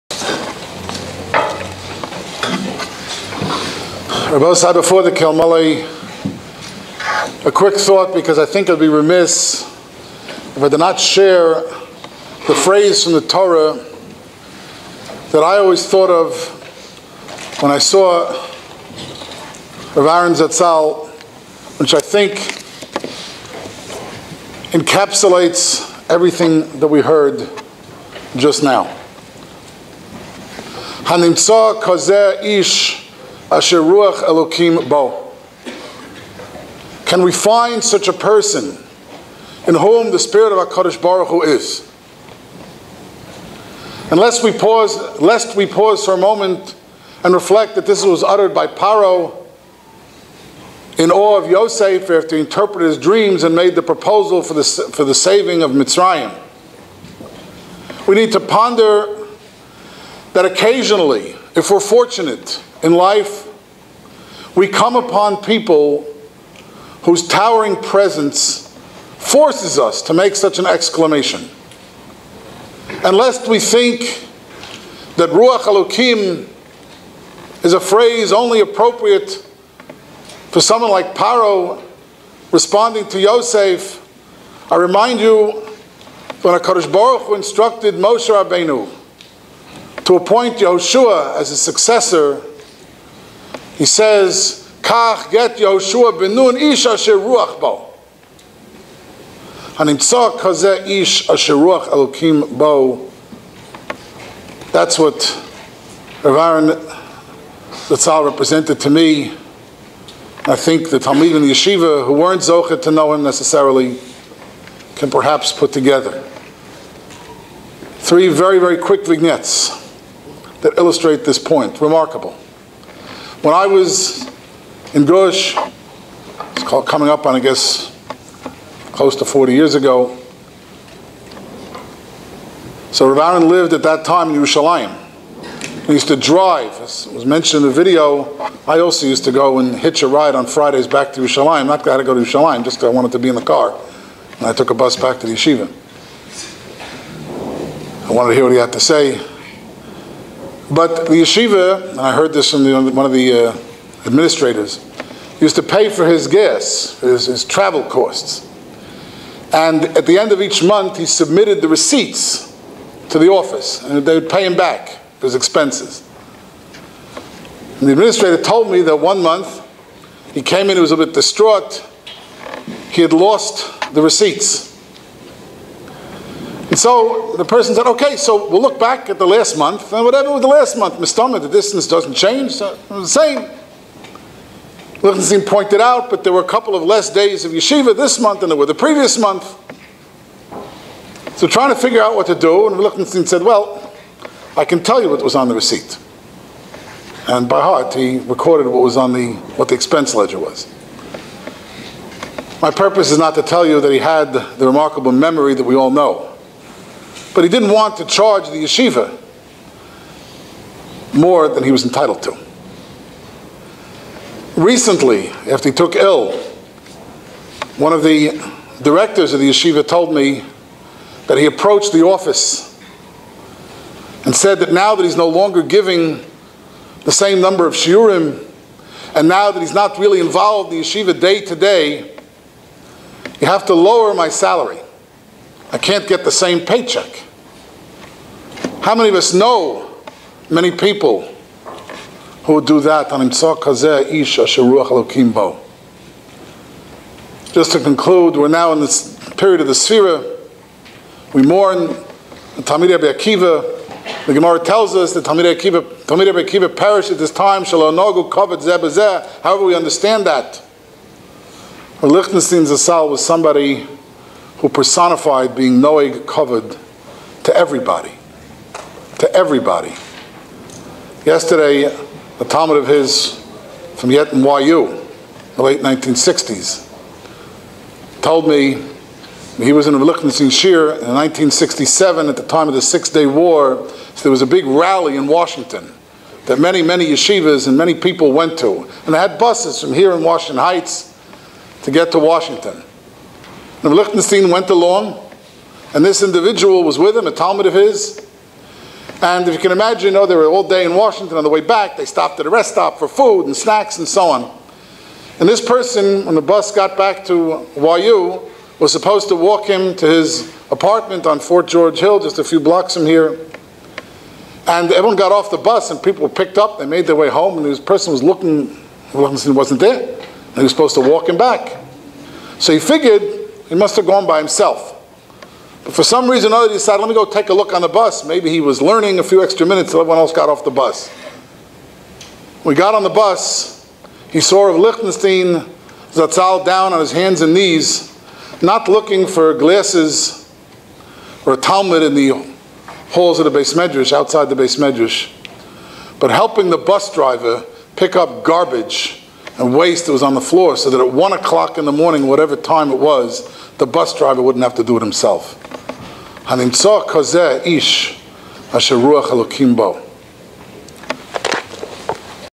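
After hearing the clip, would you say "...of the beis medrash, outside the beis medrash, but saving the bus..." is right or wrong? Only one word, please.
wrong.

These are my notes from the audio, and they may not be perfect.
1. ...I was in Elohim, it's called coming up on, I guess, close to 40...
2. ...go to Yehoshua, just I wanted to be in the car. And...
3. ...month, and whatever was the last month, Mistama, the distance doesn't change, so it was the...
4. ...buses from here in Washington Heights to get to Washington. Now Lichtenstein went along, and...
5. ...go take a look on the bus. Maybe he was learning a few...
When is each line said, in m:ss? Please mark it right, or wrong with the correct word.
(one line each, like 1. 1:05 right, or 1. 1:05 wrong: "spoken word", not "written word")
1. 2:03 wrong: "Gush", not "Elohim"
2. 2:22 wrong: "Yerushalayim", not "Yehoshua"
3. 2:59 right
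4. 4:49 right
5. 5:27 right.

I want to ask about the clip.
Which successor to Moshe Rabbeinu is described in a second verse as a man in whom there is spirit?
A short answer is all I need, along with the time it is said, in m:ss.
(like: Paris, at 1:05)
Yehoshua ben Nun, at 1:35.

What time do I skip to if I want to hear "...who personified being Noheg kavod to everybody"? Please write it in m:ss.
4:24.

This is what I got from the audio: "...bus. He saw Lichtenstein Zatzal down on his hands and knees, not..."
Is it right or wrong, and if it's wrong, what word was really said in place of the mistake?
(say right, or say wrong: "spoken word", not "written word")
right.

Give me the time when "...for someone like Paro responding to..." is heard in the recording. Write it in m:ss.
1:20.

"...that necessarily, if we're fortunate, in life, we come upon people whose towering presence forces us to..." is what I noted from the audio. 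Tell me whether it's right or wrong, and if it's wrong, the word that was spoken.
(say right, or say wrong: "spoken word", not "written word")
wrong: "occasionally", not "necessarily".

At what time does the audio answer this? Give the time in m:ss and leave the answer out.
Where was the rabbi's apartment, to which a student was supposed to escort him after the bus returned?
5:11.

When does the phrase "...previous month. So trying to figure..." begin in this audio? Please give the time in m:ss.
3:08.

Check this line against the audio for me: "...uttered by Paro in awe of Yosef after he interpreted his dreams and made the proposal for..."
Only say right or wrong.
right.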